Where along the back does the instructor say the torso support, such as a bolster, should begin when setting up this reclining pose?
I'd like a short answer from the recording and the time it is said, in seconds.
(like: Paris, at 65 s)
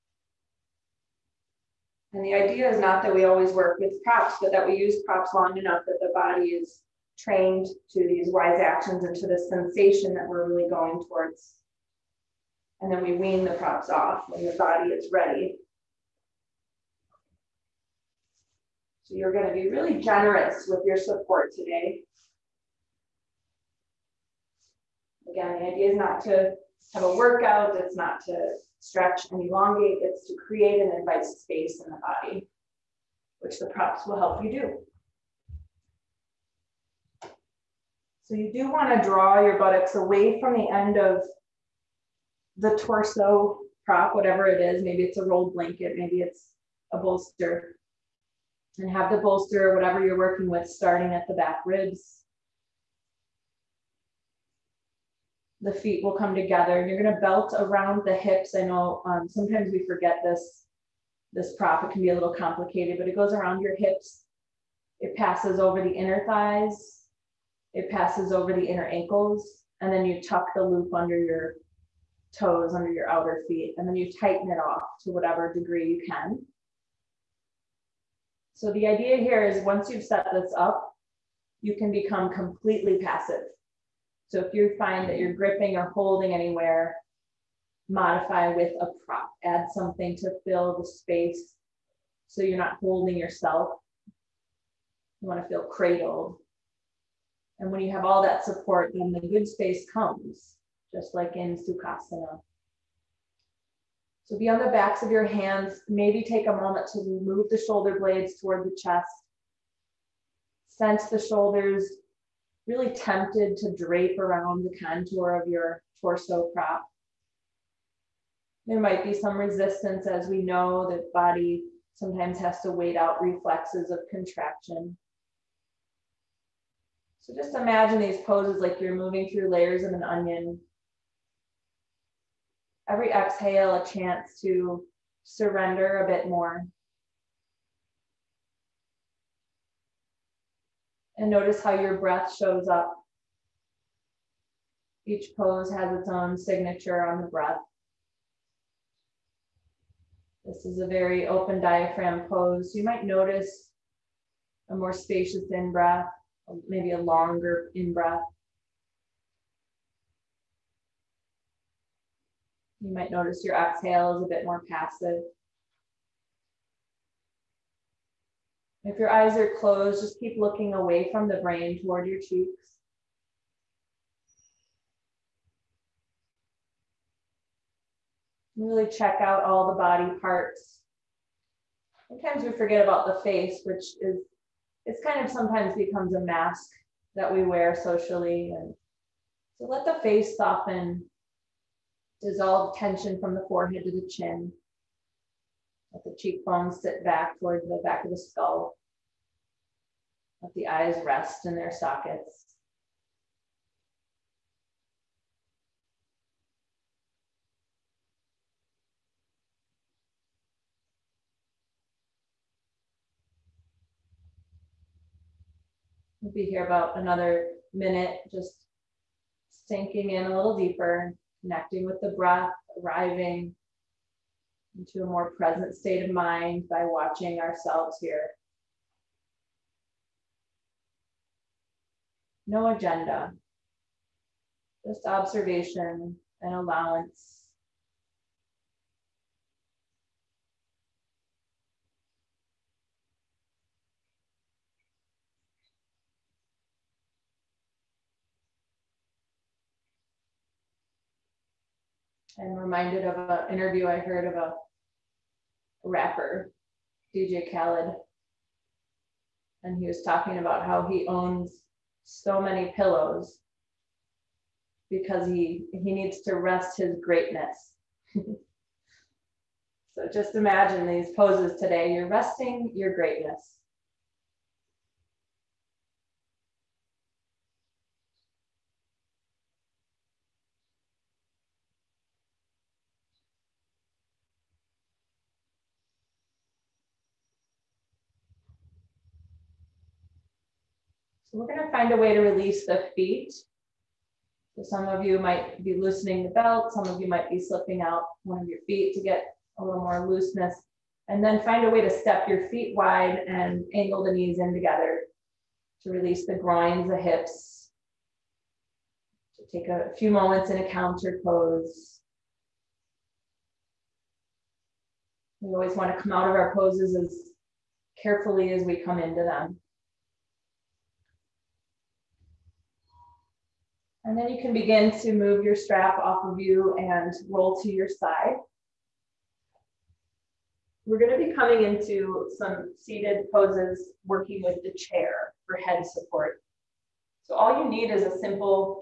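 the back ribs, at 51 s.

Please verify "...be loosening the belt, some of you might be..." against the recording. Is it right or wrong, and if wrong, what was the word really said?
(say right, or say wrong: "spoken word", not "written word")
right.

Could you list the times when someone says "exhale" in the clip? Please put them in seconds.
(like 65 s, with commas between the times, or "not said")
133 s, 163 s.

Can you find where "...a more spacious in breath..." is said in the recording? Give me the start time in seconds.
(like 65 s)
154 s.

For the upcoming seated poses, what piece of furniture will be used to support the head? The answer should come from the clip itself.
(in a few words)
the chair.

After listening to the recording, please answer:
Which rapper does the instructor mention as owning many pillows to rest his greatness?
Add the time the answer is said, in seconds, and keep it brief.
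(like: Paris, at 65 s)
DJ Khaled, at 257 s.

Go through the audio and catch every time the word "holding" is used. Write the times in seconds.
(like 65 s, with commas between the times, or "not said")
85 s, 92 s.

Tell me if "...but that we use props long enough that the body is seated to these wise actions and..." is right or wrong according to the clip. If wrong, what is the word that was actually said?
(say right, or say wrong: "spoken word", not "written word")
wrong: "trained", not "seated".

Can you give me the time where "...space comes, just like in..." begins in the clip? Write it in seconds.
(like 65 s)
99 s.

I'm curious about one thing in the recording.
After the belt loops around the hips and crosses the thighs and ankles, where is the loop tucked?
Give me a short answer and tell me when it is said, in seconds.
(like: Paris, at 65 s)
under your toes, at 70 s.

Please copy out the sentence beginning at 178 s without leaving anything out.
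Really check out all the body parts.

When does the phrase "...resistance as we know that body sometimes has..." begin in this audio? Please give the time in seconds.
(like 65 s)
119 s.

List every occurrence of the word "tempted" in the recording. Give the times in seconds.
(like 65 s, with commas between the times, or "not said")
112 s.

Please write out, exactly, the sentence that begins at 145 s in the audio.
Each pose has its own signature on the breath.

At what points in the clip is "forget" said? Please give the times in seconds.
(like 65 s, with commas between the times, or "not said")
59 s, 182 s.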